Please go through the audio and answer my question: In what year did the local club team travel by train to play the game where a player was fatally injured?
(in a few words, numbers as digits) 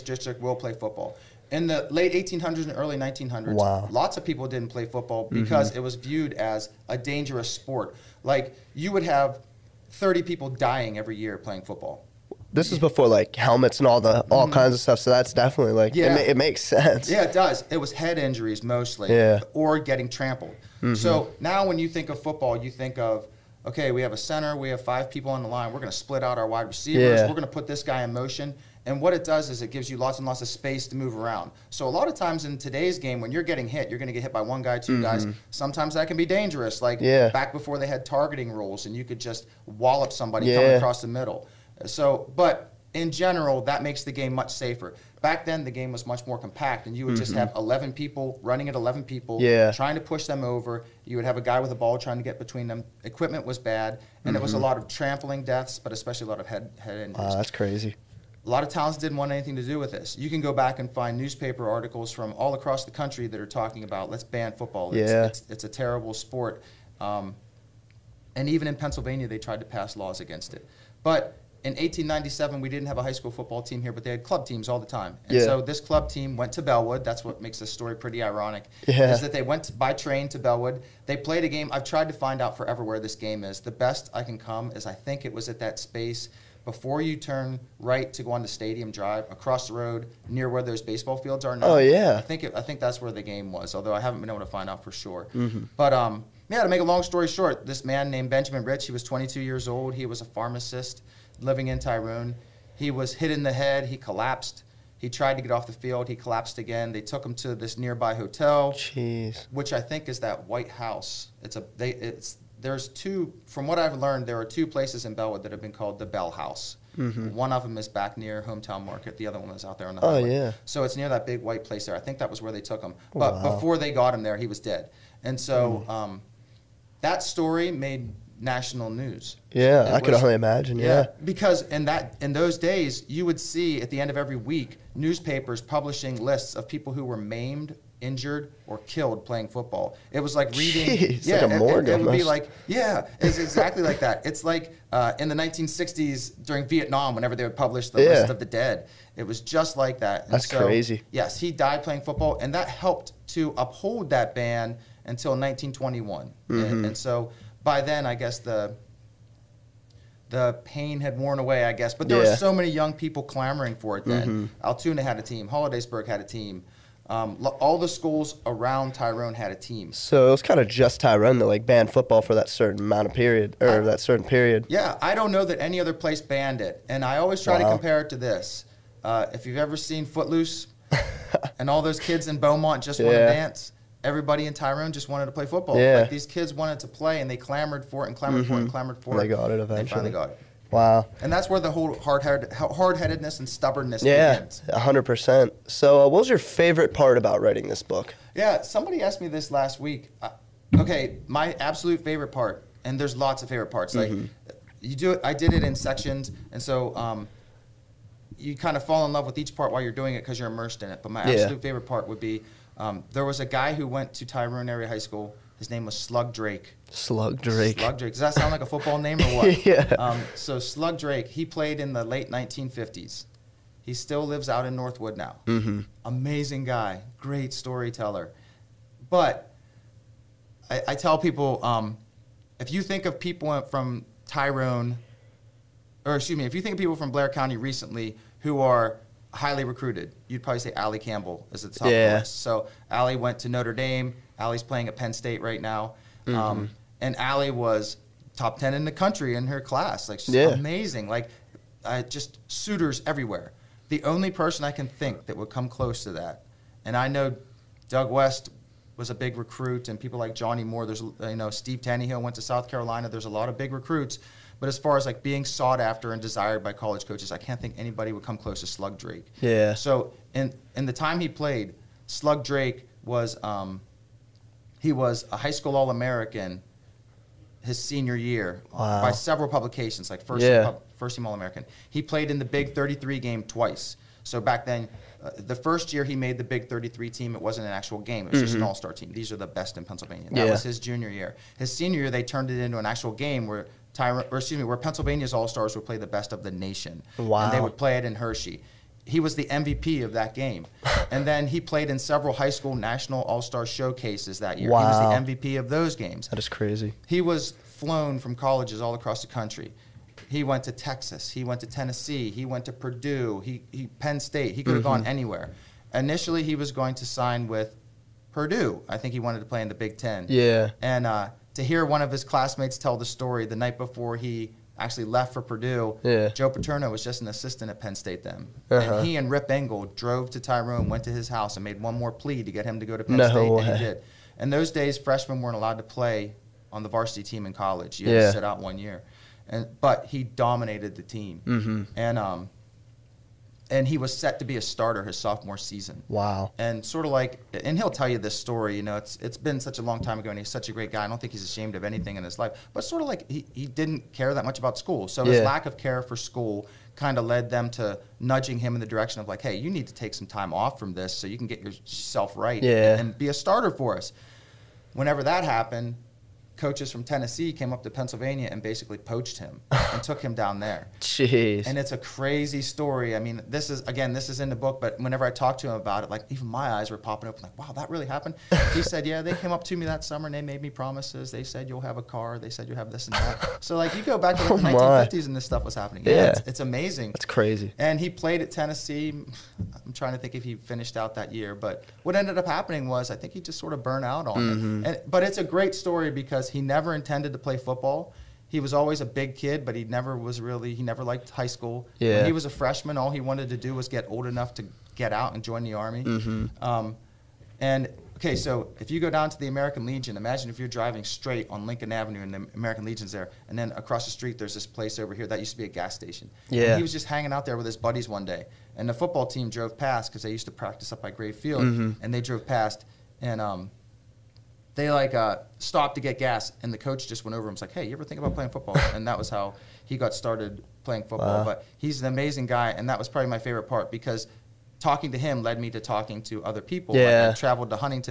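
1897.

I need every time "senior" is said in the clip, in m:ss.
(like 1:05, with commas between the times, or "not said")
4:37, 4:51.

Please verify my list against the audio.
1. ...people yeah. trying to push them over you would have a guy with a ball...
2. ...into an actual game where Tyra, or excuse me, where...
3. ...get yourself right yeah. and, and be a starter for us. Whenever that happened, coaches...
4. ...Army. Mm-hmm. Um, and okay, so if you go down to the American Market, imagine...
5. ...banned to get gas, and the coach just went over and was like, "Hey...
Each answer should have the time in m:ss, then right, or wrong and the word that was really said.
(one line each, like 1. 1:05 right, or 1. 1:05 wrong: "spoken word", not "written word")
1. 0:49 right
2. 4:52 right
3. 6:01 right
4. 6:45 wrong: "Legion", not "Market"
5. 7:05 wrong: "stopped", not "banned".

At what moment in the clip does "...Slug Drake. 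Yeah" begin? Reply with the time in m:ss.
4:28.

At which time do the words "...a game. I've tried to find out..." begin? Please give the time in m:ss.
1:21.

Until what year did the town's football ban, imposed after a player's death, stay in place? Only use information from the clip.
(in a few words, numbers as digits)
1921.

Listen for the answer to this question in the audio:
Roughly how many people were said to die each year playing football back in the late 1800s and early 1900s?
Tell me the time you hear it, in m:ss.
0:09.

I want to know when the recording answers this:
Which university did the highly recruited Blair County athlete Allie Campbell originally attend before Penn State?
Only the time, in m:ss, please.
4:03.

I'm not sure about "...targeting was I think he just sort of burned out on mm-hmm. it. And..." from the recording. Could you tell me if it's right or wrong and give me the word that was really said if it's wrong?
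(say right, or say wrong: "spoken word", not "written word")
wrong: "happening", not "targeting".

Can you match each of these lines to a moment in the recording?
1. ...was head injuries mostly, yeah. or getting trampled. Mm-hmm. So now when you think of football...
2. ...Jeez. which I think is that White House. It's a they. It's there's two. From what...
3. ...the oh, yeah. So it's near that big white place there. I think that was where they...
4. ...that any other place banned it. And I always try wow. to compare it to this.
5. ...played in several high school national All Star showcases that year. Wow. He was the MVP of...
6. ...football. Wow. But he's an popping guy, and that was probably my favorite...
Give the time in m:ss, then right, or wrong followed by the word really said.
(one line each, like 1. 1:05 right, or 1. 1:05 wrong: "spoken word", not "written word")
1. 0:17 right
2. 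1:48 right
3. 1:59 right
4. 2:55 right
5. 5:01 right
6. 7:11 wrong: "amazing", not "popping".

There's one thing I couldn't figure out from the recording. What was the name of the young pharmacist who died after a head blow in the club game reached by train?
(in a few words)
Benjamin Rich.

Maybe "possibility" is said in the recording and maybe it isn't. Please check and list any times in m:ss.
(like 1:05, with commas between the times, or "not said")
not said.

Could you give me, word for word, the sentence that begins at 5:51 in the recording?
I don't think he's ashamed of anything in his life.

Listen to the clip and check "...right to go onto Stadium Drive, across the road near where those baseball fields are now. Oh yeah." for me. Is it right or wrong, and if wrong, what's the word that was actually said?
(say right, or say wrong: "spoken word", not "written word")
right.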